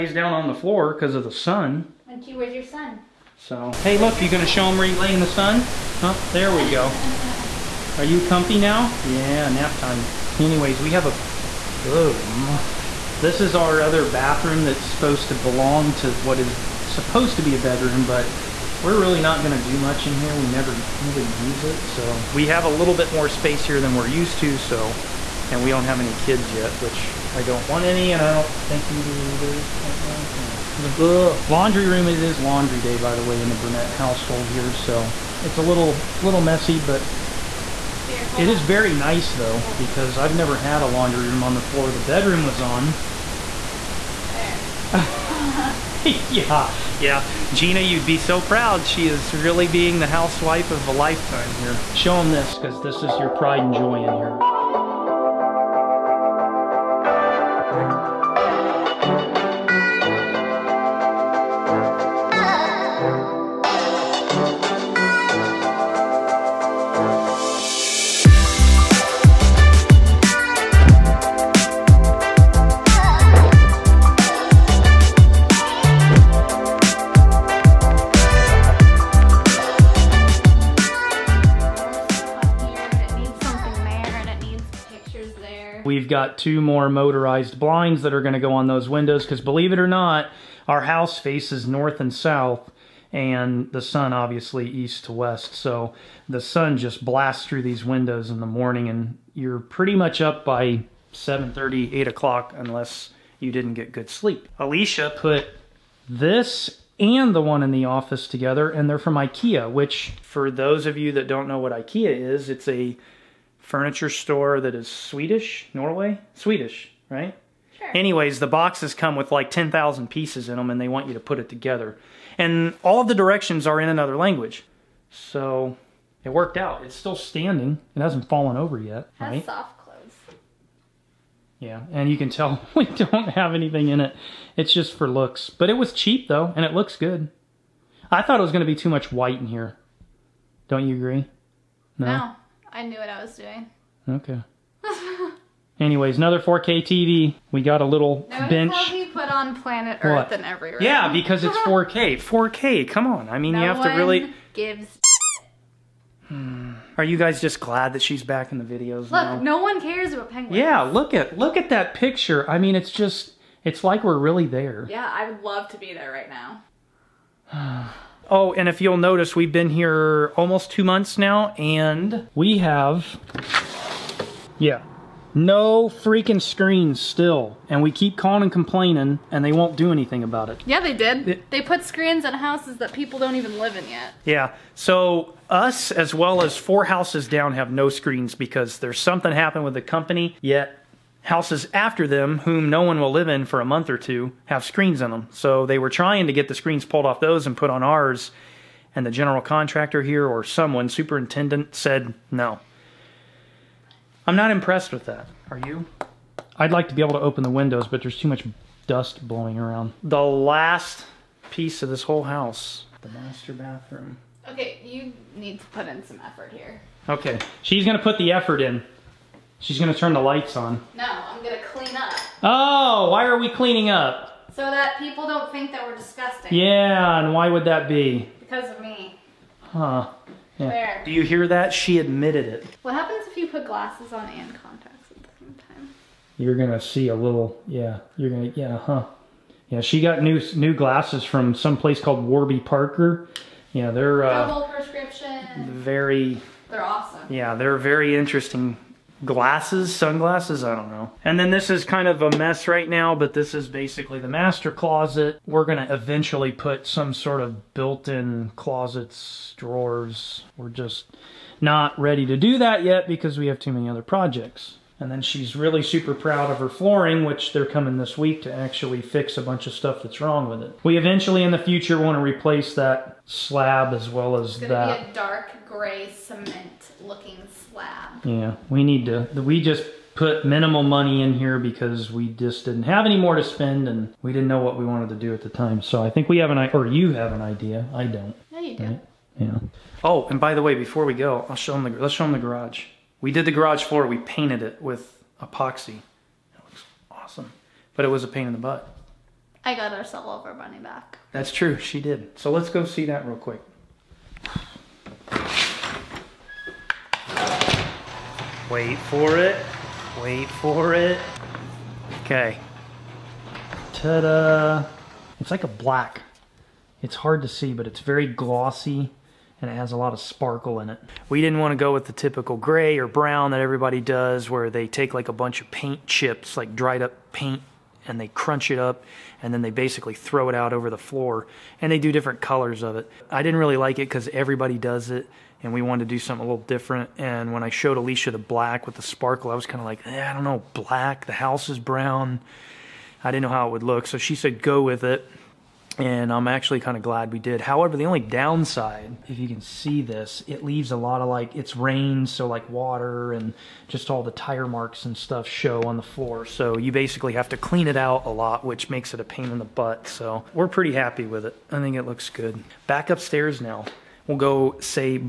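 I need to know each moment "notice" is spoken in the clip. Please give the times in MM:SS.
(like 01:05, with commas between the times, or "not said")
02:28, 02:48.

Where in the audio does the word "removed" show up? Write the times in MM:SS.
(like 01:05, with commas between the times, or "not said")
not said.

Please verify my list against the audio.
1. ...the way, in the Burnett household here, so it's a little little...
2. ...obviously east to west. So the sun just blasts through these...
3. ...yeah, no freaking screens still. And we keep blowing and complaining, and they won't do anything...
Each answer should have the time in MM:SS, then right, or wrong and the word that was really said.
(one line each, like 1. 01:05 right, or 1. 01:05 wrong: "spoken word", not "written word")
1. 00:33 right
2. 01:34 right
3. 02:54 wrong: "calling", not "blowing".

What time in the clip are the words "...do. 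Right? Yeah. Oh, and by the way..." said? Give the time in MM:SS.
04:48.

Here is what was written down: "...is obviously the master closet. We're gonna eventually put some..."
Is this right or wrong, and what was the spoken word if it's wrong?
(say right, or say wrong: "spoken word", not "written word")
wrong: "basically", not "obviously".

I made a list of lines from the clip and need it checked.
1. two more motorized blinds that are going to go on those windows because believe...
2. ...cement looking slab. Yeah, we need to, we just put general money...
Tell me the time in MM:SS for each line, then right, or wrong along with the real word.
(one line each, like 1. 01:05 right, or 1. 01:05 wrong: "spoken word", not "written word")
1. 01:26 right
2. 04:36 wrong: "minimal", not "general".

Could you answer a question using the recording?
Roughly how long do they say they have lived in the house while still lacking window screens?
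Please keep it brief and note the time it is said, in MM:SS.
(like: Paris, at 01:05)
almost two months, at 02:50.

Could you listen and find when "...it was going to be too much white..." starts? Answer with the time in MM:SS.
02:18.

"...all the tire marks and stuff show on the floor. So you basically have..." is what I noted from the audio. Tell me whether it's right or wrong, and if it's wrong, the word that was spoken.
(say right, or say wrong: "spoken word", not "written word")
right.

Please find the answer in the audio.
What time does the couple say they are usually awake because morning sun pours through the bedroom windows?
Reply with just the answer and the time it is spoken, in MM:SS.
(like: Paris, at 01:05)
7:30, at 01:41.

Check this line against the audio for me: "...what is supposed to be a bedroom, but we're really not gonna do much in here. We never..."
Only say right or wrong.
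right.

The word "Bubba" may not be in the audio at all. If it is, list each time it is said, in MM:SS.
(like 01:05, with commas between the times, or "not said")
not said.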